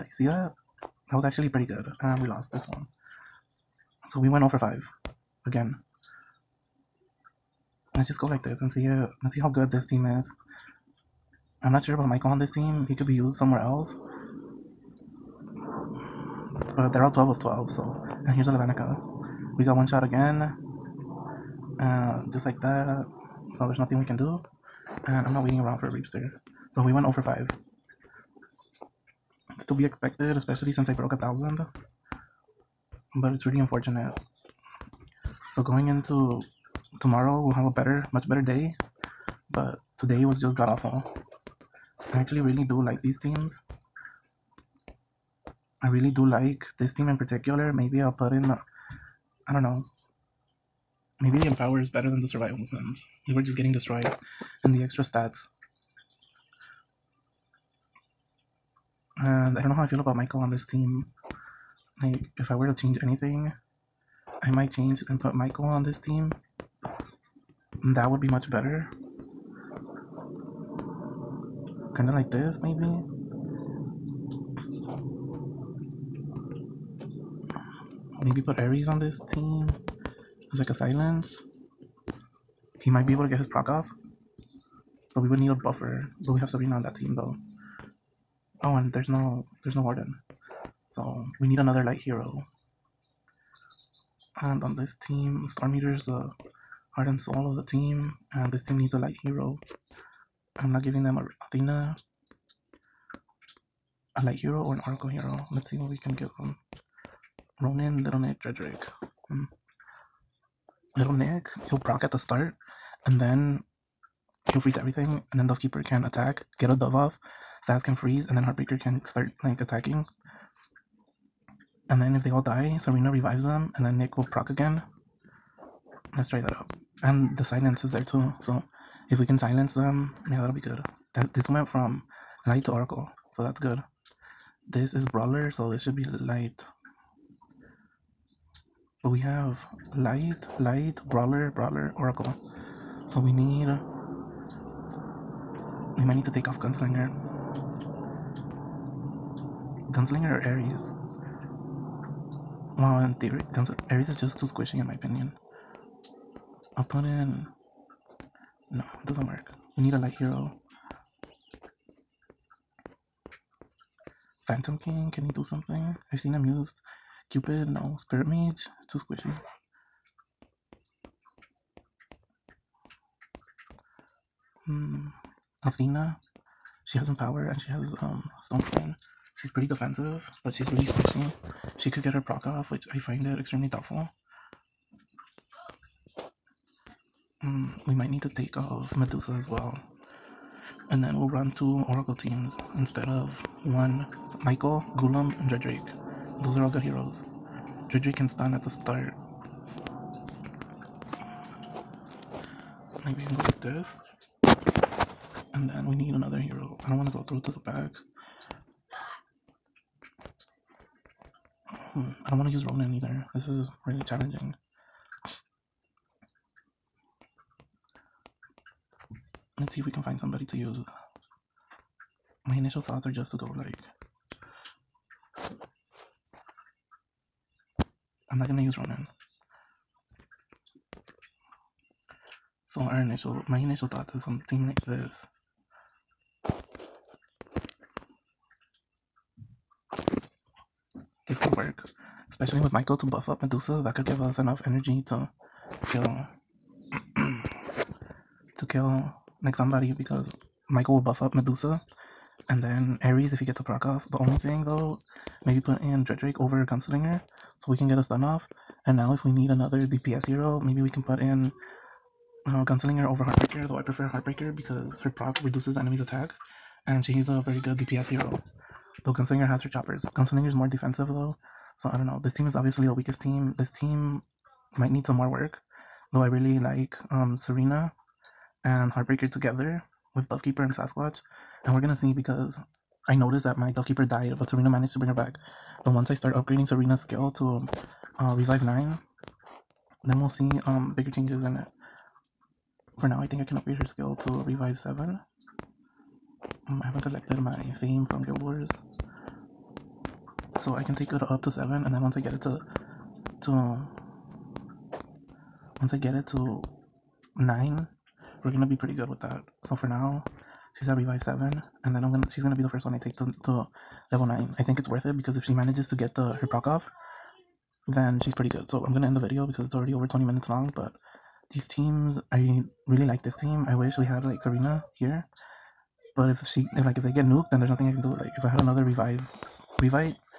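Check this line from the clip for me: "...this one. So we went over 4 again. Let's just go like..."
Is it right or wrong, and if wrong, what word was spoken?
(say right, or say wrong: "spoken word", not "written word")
wrong: "5", not "4".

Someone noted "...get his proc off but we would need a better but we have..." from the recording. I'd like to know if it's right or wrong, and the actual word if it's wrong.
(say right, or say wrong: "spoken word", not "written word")
wrong: "buffer", not "better".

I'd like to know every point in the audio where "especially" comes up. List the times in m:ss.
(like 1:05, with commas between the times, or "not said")
0:30, 4:02.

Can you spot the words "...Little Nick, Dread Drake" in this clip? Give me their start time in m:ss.
1:48.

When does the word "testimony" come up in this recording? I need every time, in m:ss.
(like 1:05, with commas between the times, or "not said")
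not said.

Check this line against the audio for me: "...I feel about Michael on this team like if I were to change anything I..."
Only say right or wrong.
right.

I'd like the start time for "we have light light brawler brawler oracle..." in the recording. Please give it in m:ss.
2:19.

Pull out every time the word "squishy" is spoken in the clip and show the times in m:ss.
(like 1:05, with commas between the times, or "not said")
2:34, 2:48, 3:00.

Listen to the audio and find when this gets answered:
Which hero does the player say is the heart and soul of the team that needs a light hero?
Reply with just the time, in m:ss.
1:35.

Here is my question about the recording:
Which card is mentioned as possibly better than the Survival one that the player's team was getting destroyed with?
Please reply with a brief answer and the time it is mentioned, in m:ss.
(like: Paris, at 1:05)
Empower, at 0:51.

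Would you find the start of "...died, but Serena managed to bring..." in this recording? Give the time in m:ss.
4:44.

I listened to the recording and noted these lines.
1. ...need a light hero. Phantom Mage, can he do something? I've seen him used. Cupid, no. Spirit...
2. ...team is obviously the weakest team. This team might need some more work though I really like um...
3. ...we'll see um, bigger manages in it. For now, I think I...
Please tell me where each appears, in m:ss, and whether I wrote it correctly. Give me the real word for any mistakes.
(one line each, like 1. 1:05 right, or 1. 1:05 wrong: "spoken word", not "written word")
1. 2:39 wrong: "King", not "Mage"
2. 4:32 right
3. 4:50 wrong: "changes", not "manages".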